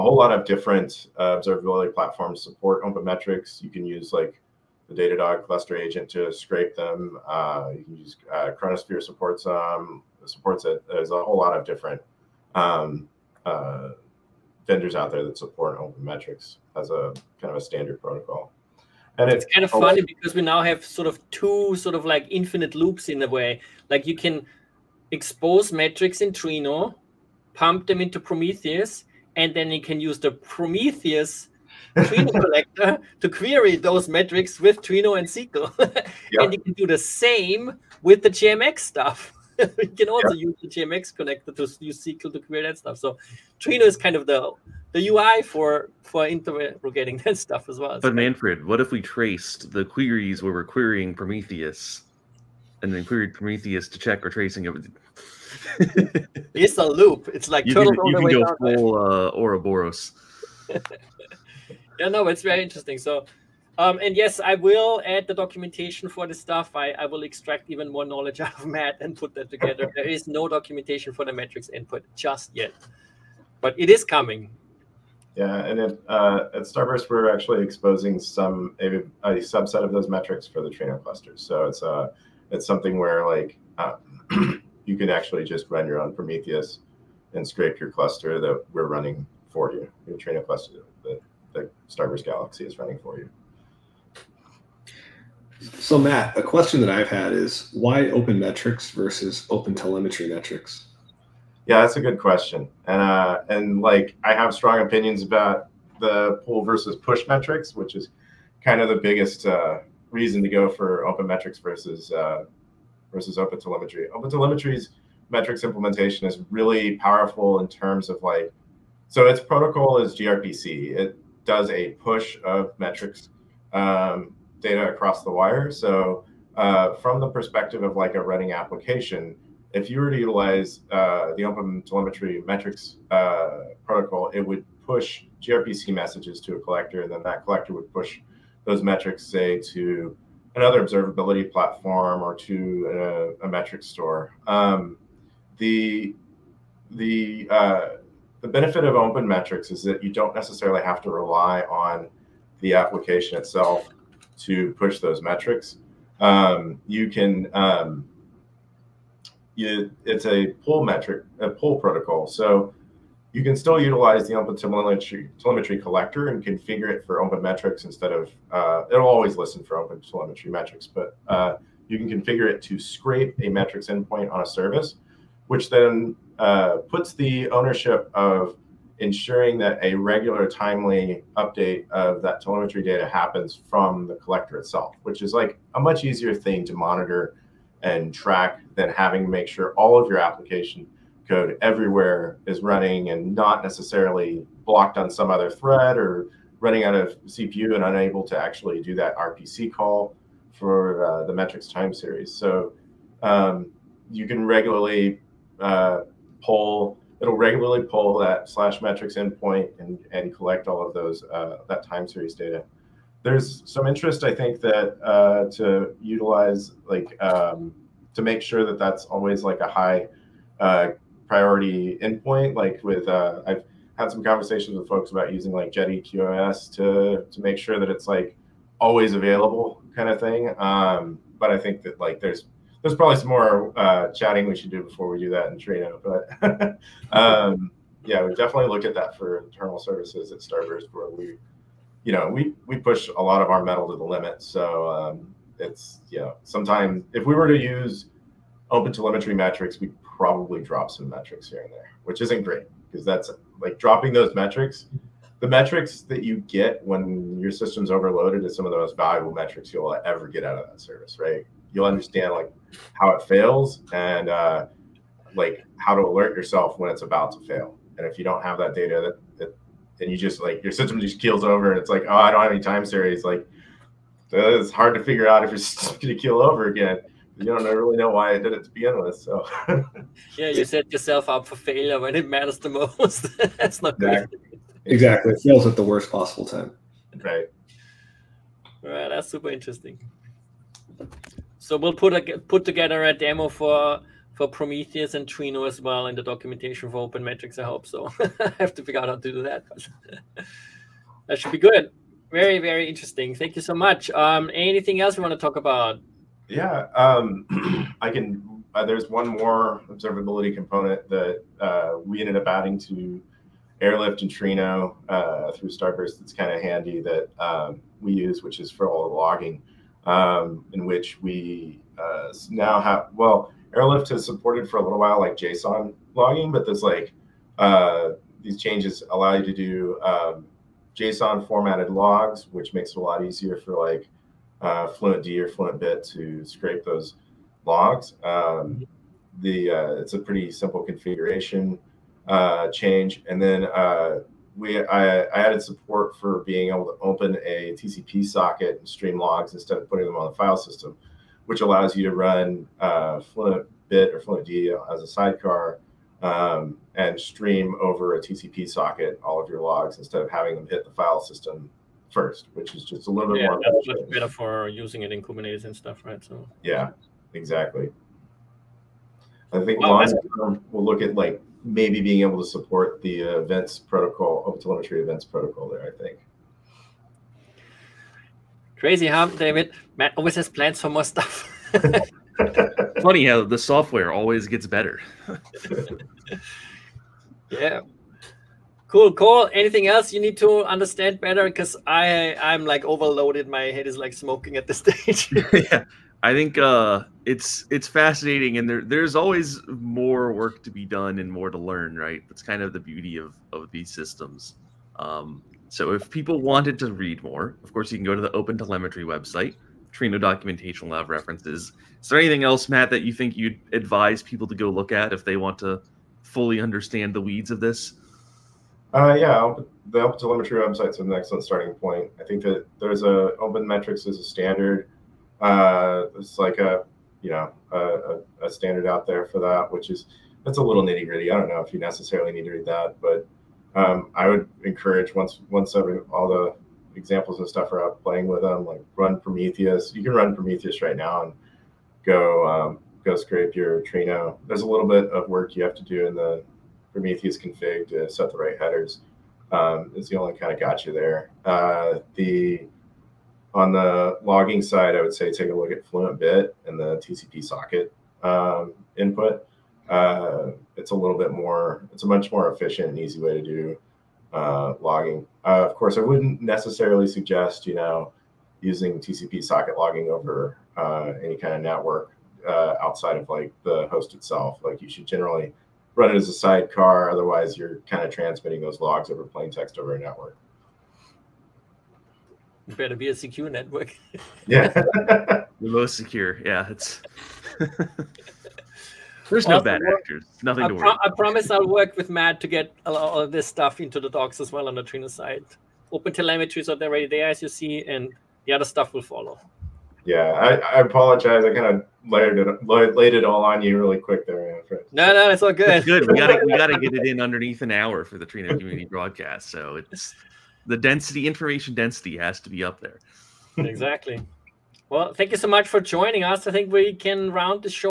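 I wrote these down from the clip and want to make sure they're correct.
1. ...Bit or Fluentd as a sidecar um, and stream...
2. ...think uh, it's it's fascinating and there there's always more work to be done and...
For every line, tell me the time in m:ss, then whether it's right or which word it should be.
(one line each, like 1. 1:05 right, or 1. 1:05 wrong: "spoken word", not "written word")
1. 5:53 right
2. 6:36 right.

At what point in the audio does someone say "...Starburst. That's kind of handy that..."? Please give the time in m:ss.
5:15.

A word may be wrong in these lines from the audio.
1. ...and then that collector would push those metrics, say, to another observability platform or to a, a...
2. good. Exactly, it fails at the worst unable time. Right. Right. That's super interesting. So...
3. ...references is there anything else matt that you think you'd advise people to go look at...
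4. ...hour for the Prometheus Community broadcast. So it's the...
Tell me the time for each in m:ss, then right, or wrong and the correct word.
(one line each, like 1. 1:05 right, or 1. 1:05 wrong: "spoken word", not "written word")
1. 2:17 right
2. 4:44 wrong: "possible", not "unable"
3. 6:51 right
4. 8:27 wrong: "Trino", not "Prometheus".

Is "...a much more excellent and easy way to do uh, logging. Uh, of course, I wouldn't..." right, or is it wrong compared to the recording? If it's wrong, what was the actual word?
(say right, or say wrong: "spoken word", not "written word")
wrong: "efficient", not "excellent".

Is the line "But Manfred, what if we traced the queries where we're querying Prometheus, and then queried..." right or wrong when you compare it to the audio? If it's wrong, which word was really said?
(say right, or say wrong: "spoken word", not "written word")
right.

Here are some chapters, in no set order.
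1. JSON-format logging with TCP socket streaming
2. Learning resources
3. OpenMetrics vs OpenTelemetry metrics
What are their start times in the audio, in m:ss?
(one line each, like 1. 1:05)
1. 5:04
2. 6:26
3. 1:34.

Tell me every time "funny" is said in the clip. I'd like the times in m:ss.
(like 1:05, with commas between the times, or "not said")
0:19, 6:23.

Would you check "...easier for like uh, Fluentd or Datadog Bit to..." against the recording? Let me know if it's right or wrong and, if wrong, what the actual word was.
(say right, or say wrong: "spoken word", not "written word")
wrong: "Fluent", not "Datadog".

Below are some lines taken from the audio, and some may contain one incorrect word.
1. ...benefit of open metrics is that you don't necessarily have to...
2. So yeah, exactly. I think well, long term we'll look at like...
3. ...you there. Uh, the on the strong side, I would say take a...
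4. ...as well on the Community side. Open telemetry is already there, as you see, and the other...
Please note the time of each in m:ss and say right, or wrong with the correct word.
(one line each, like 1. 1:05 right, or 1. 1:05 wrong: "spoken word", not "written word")
1. 2:28 right
2. 6:06 right
3. 7:30 wrong: "logging", not "strong"
4. 8:14 wrong: "Trino", not "Community".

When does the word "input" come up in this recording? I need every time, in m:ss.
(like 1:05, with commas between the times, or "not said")
1:11, 7:38.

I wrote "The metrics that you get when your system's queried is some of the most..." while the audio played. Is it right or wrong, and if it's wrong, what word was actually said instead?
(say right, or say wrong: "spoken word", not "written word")
wrong: "overloaded", not "queried".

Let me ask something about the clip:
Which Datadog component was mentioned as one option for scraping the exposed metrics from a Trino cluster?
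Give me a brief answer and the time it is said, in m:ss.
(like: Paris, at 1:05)
Datadog cluster agent, at 0:04.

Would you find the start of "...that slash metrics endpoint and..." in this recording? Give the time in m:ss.
3:28.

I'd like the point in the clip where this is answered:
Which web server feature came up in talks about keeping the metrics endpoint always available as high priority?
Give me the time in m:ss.
3:45.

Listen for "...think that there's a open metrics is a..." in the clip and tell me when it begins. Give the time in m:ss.
7:02.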